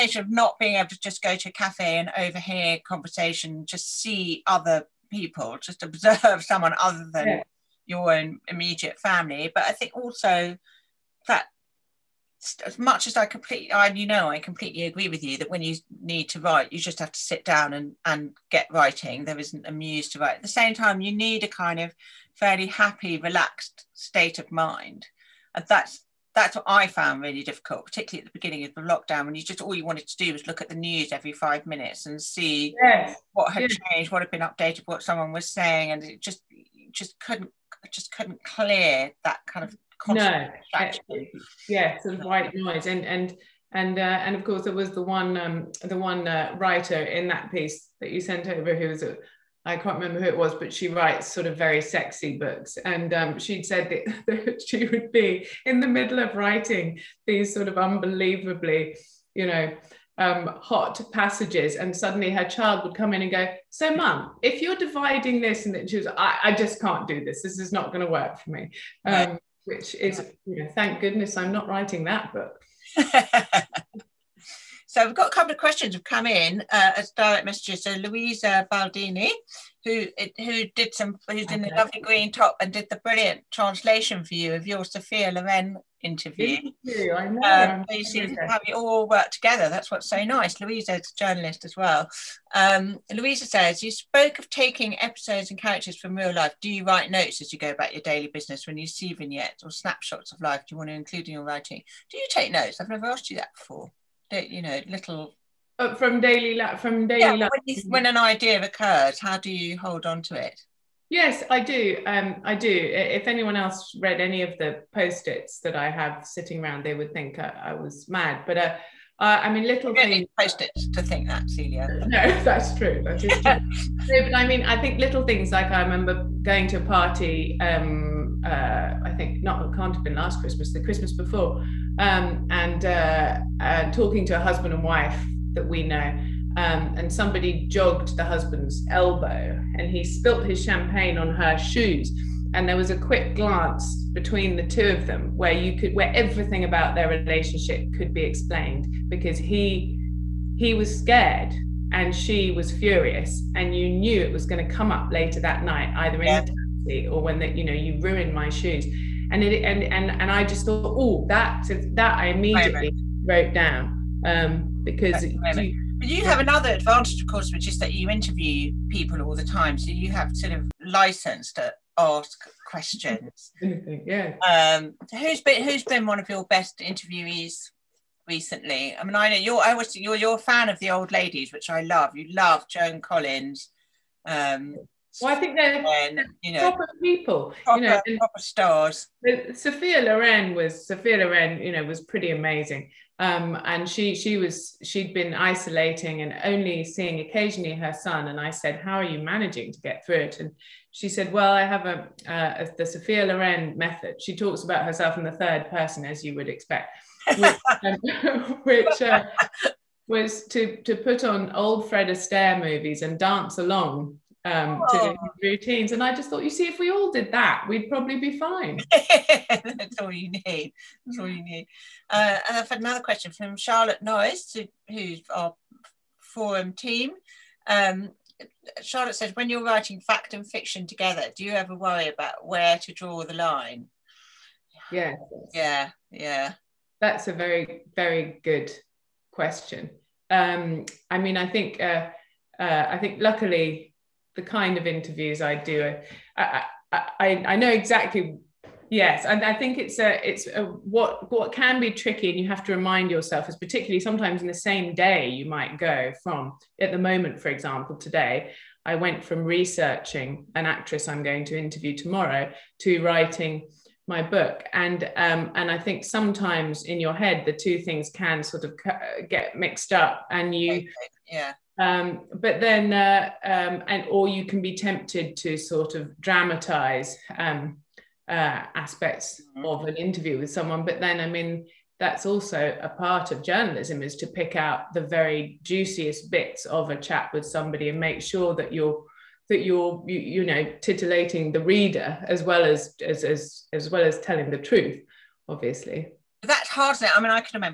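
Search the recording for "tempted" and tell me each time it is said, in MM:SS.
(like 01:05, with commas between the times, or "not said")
04:34.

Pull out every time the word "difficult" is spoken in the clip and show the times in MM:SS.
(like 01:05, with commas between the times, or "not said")
00:27.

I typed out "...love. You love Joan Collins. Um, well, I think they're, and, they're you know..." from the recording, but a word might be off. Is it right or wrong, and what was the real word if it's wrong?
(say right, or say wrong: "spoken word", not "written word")
right.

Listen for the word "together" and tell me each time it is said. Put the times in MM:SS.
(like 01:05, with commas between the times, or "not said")
01:29, 03:50.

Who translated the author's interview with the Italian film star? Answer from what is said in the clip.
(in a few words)
Louisa Baldini.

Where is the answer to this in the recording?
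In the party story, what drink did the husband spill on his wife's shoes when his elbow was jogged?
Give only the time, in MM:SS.
02:20.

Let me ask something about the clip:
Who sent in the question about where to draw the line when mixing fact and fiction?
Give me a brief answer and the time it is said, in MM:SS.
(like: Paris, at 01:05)
Charlotte Noyes, at 03:43.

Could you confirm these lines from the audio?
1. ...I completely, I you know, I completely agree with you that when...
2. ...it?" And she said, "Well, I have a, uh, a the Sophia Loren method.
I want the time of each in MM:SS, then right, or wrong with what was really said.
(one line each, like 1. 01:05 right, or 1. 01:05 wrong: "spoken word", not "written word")
1. 00:13 right
2. 03:20 right.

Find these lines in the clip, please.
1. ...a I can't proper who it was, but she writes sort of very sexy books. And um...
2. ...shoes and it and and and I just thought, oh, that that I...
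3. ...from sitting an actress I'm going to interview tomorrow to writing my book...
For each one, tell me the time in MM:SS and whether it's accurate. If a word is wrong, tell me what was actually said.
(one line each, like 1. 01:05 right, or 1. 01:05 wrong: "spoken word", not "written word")
1. 00:49 wrong: "remember", not "proper"
2. 02:38 right
3. 04:19 wrong: "researching", not "sitting".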